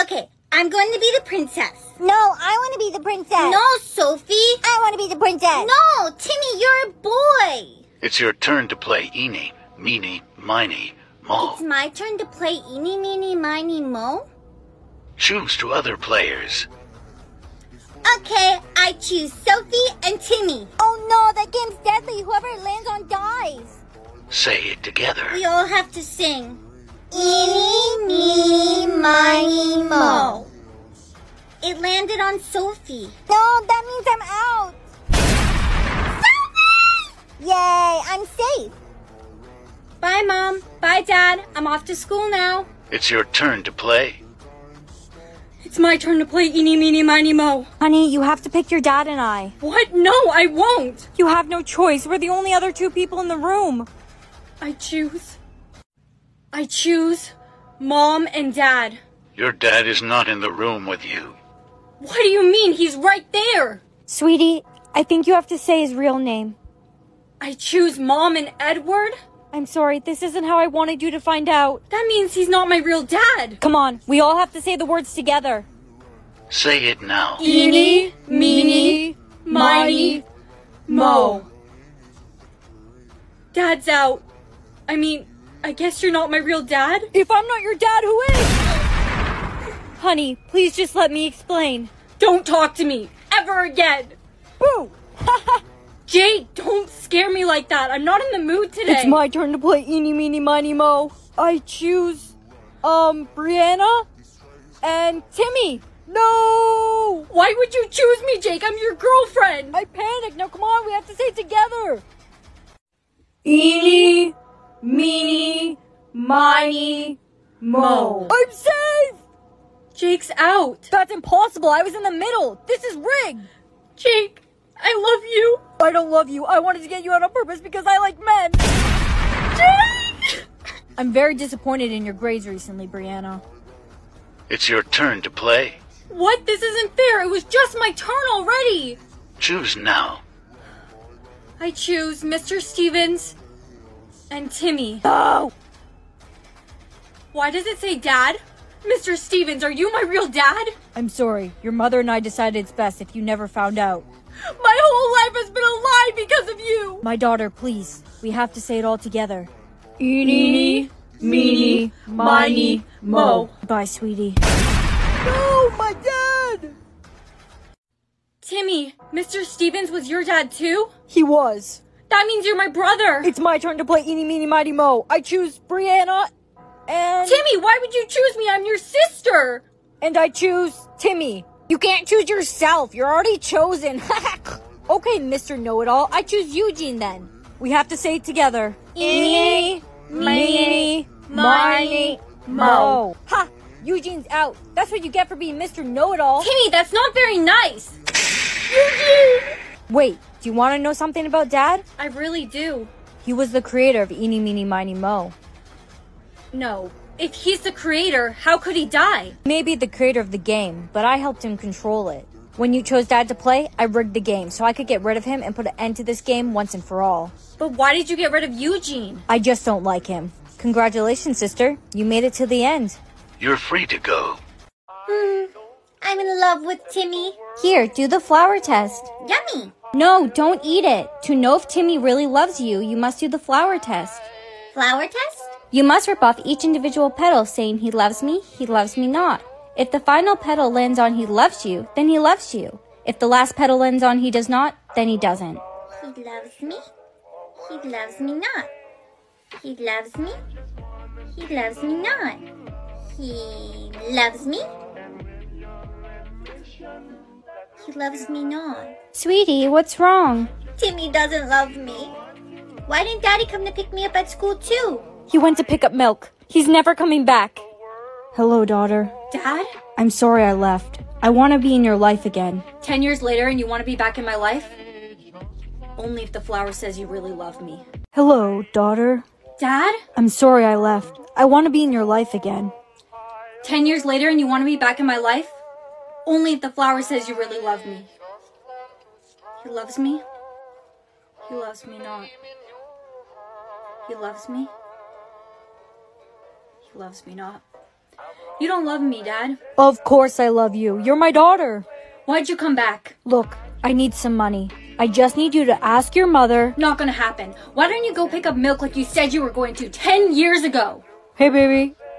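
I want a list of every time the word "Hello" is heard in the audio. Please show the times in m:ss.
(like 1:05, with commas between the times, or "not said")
4:28, 4:38.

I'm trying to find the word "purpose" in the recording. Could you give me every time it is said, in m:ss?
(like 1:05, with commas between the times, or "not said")
2:07.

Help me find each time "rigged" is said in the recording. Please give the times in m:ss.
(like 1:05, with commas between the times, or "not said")
2:02, 3:33.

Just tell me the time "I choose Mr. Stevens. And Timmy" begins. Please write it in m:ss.
2:21.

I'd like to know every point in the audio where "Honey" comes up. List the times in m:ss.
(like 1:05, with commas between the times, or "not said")
0:47, 1:30.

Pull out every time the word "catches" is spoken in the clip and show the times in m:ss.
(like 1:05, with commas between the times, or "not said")
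not said.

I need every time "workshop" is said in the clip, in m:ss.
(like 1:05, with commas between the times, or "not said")
not said.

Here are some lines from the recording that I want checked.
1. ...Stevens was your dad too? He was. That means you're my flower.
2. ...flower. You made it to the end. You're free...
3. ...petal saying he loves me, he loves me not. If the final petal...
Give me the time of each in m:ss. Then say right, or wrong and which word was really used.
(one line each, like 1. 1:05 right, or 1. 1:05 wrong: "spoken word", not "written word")
1. 2:49 wrong: "brother", not "flower"
2. 3:41 wrong: "sister", not "flower"
3. 3:57 right.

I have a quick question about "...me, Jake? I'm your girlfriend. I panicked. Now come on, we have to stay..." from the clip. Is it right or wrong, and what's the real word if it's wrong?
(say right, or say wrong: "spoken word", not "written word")
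right.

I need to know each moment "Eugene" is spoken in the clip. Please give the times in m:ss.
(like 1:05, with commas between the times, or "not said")
3:06, 3:13, 3:18, 3:38.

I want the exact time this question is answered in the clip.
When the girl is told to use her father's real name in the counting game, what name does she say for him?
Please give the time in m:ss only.
1:08.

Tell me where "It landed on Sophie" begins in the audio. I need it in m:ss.
0:31.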